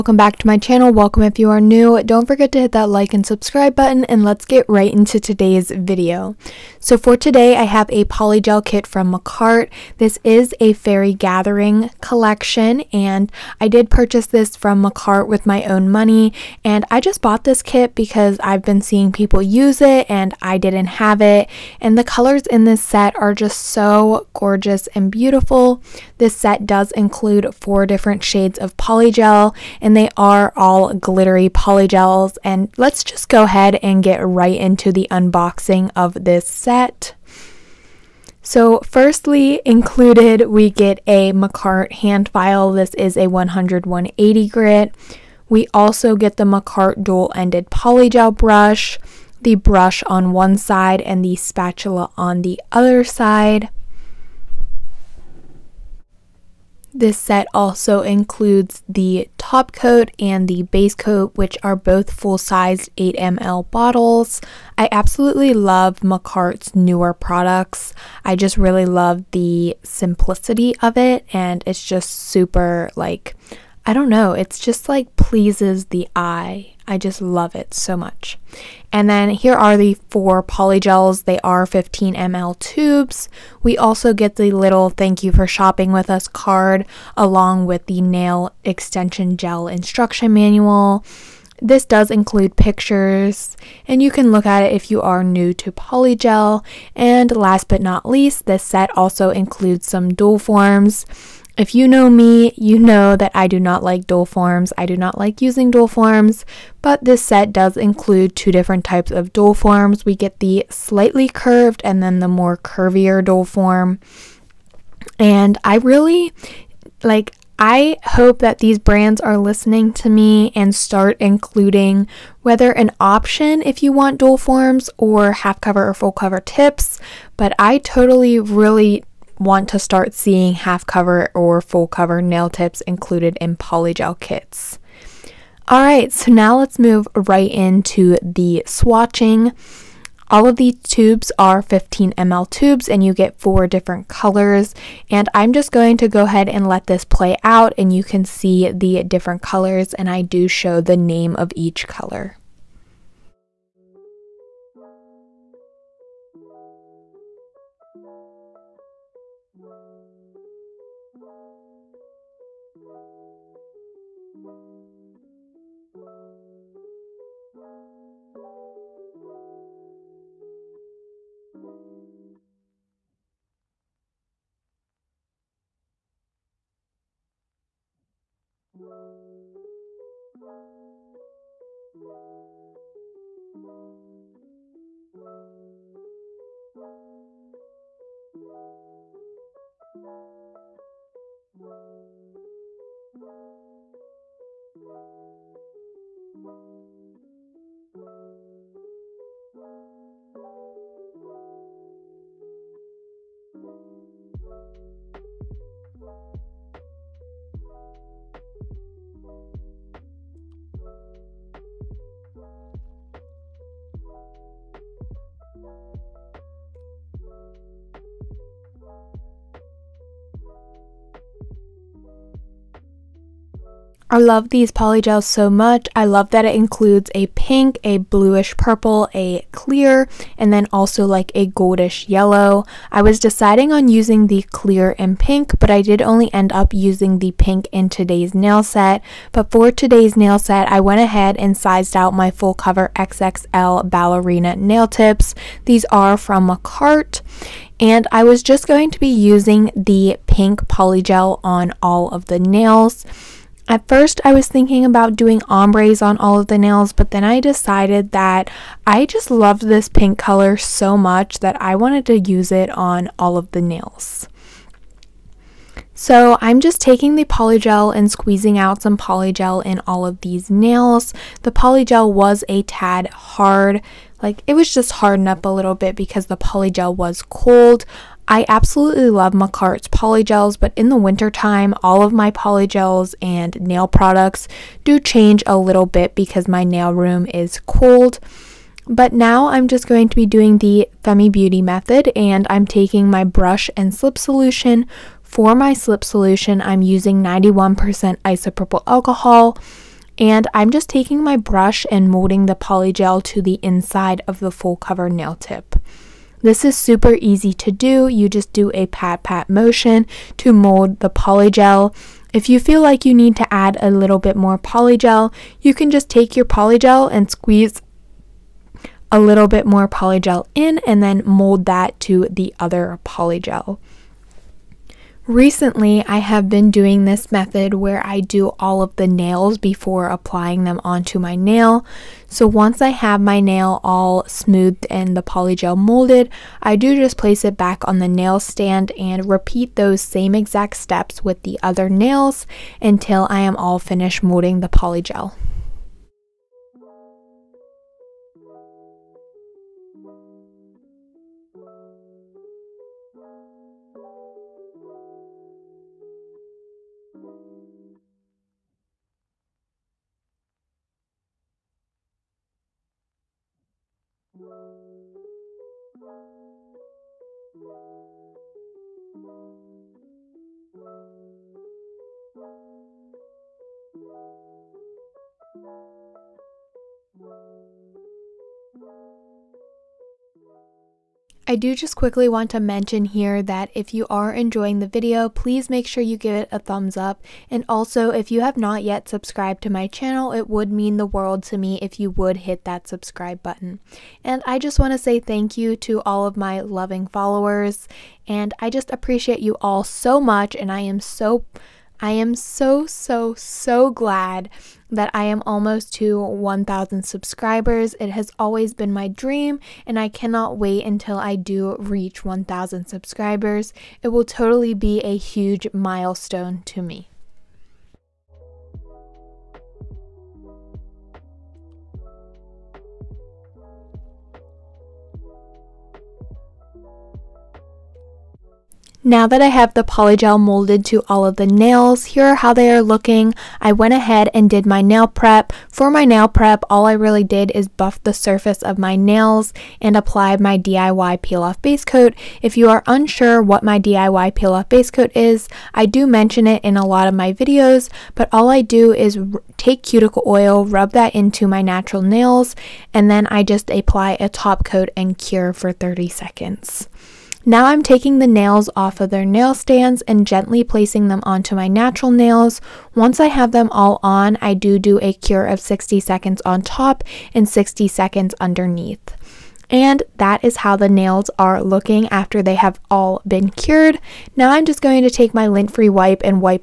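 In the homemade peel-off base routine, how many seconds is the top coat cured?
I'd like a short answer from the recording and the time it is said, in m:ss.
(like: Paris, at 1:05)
30, at 7:35.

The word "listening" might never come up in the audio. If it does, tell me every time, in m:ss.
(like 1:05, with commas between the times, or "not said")
1:59.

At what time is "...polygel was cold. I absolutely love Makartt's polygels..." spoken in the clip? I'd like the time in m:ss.
4:36.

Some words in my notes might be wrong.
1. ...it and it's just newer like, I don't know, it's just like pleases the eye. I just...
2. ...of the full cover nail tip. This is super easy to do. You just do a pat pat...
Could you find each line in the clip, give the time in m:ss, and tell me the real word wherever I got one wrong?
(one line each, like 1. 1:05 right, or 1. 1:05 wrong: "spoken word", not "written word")
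1. 1:10 wrong: "super", not "newer"
2. 5:04 right.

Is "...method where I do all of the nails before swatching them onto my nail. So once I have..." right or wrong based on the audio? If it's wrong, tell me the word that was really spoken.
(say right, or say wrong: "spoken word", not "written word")
wrong: "applying", not "swatching".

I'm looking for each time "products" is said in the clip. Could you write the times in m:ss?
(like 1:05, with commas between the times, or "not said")
1:07, 4:43.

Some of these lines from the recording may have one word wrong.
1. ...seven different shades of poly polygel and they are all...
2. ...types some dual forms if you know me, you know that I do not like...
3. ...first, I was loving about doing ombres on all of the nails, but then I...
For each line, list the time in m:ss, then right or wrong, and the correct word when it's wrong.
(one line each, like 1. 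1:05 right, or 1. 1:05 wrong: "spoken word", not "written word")
1. 0:27 wrong: "four", not "seven"
2. 1:39 wrong: "includes", not "types"
3. 4:13 wrong: "thinking", not "loving".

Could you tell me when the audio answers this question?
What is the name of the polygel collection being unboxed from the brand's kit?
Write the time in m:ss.
0:10.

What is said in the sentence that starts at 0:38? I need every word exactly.
So, firstly, included, we get a Makartt hand file.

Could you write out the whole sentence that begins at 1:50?
We get the slightly curved and then the more curvier dual form.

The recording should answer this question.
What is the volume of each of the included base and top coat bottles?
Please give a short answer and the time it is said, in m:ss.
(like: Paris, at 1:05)
8ml, at 1:02.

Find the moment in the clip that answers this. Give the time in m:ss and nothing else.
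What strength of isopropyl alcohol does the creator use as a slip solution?
4:57.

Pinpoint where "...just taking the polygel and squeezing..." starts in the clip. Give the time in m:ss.
4:26.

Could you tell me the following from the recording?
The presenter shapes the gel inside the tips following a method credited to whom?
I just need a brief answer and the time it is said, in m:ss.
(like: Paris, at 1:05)
Femi Beauty, at 4:51.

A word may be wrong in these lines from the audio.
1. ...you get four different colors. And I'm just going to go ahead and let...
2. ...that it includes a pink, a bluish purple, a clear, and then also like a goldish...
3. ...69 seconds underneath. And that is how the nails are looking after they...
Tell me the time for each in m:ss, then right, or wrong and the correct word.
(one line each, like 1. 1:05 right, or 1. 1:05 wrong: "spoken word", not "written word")
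1. 2:23 right
2. 3:46 right
3. 7:47 wrong: "60", not "69".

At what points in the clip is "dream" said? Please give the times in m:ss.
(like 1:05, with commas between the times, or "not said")
6:49.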